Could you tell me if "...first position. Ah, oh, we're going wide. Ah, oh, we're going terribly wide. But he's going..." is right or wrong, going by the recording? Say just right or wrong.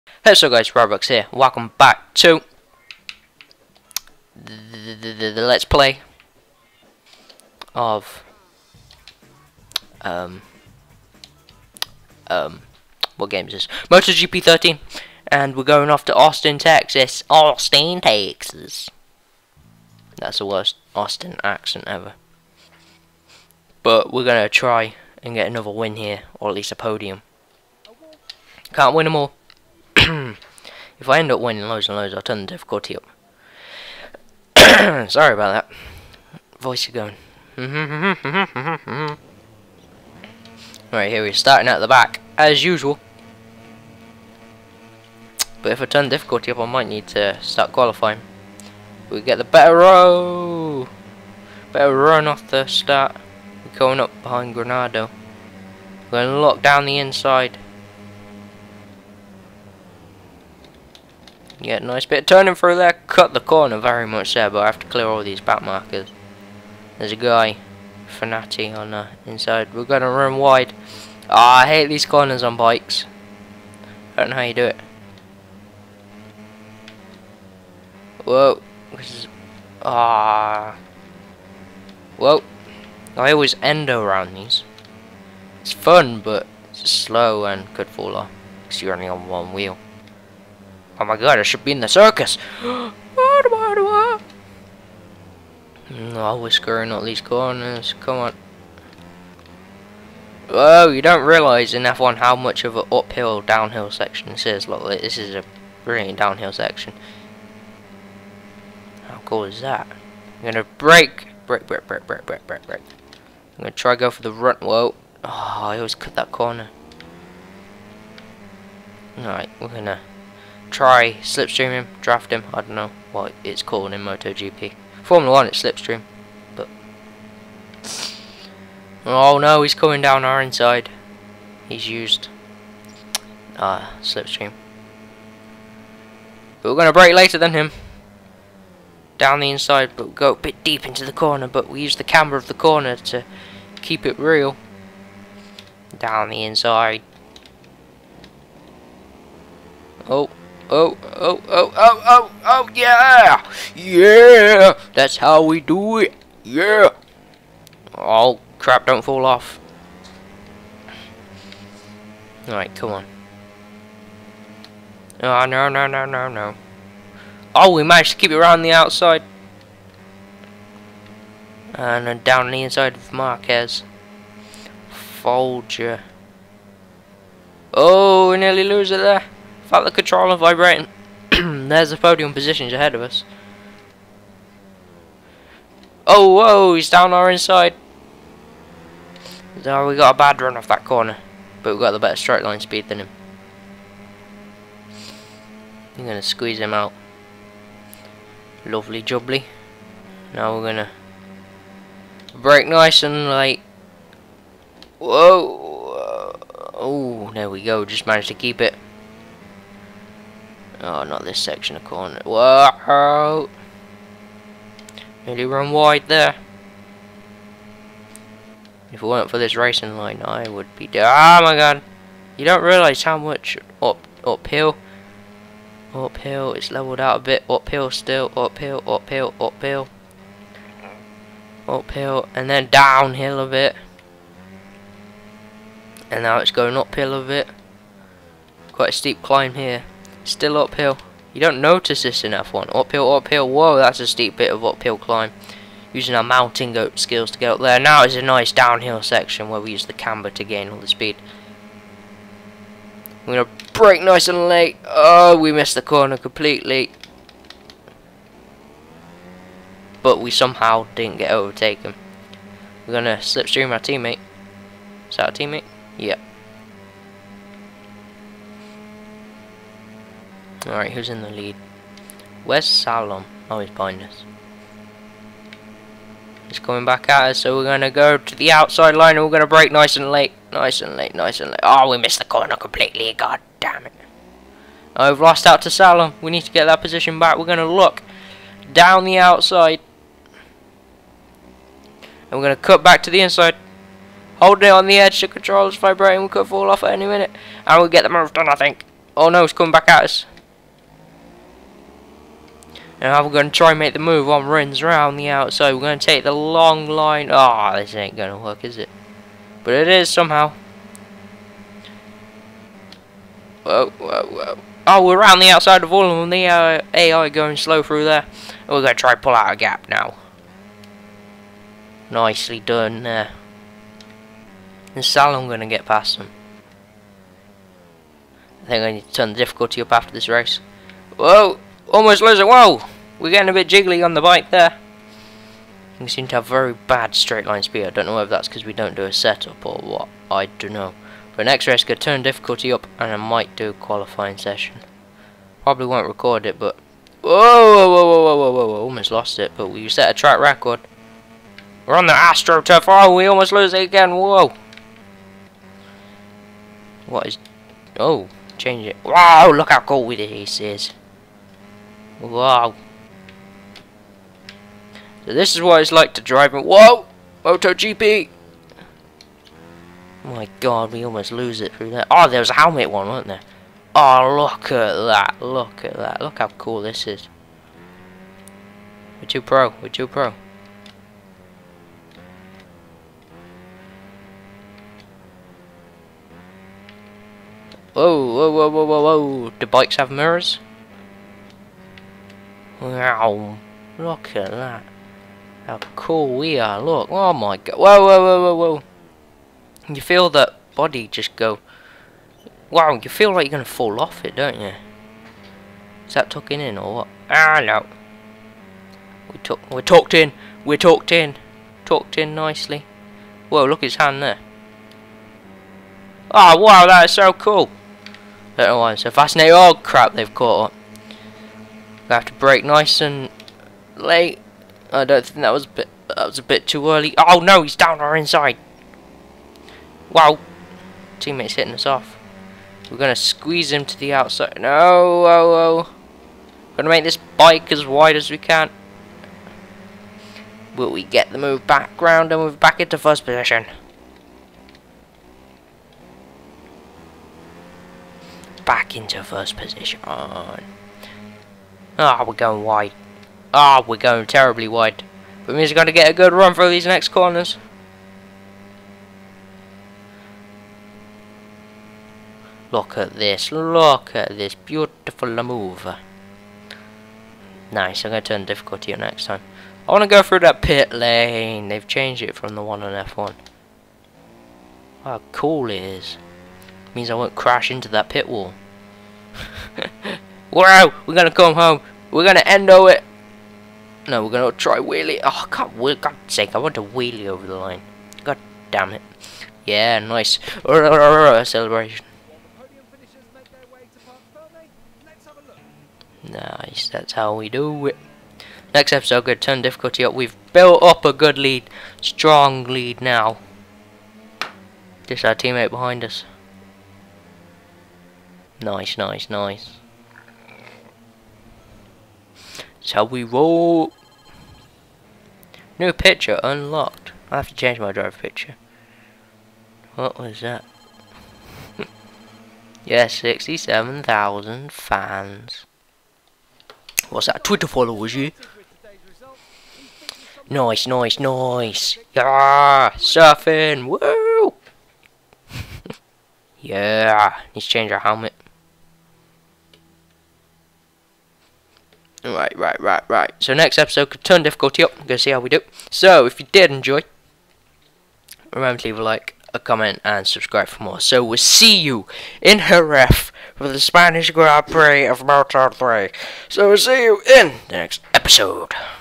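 right.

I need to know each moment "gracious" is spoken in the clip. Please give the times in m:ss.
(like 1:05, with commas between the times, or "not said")
not said.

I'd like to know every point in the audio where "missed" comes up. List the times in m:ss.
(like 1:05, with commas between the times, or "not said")
4:15, 4:41.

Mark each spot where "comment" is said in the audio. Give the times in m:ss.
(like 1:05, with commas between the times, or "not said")
9:09.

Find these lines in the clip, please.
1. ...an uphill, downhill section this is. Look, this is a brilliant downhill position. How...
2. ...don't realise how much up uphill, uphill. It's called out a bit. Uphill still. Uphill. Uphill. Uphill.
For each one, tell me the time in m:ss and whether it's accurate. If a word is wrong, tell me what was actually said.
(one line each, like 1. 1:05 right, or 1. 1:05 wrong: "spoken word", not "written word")
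1. 1:42 wrong: "section", not "position"
2. 3:42 wrong: "leveled", not "called".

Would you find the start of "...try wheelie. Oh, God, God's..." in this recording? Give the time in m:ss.
8:04.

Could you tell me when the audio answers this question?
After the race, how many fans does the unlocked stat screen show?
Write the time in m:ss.
8:43.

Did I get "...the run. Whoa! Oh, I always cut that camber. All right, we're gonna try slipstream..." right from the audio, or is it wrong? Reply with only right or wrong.
wrong.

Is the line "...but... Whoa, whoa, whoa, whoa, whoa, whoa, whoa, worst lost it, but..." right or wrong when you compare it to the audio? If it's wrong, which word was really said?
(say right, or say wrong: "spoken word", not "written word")
wrong: "almost", not "worst".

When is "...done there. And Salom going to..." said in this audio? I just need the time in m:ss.
5:22.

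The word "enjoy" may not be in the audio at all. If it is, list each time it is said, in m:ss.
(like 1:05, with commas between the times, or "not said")
9:06.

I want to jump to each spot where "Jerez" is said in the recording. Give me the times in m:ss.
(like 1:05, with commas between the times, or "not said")
9:12.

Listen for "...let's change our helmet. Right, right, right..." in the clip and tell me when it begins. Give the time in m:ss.
8:57.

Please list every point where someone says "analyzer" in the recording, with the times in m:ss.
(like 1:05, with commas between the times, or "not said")
not said.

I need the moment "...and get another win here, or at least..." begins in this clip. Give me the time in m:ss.
0:25.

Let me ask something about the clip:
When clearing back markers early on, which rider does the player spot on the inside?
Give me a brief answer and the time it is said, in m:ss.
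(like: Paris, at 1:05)
Fenati, at 1:08.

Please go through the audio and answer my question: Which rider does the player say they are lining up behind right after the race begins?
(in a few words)
Granado.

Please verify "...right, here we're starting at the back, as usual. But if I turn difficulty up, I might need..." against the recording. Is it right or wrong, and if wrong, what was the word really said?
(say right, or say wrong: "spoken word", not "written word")
right.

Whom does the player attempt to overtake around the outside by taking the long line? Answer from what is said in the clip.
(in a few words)
Rins.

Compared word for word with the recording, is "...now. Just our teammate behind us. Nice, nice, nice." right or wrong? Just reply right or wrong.
right.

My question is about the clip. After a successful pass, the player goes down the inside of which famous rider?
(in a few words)
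Marquez.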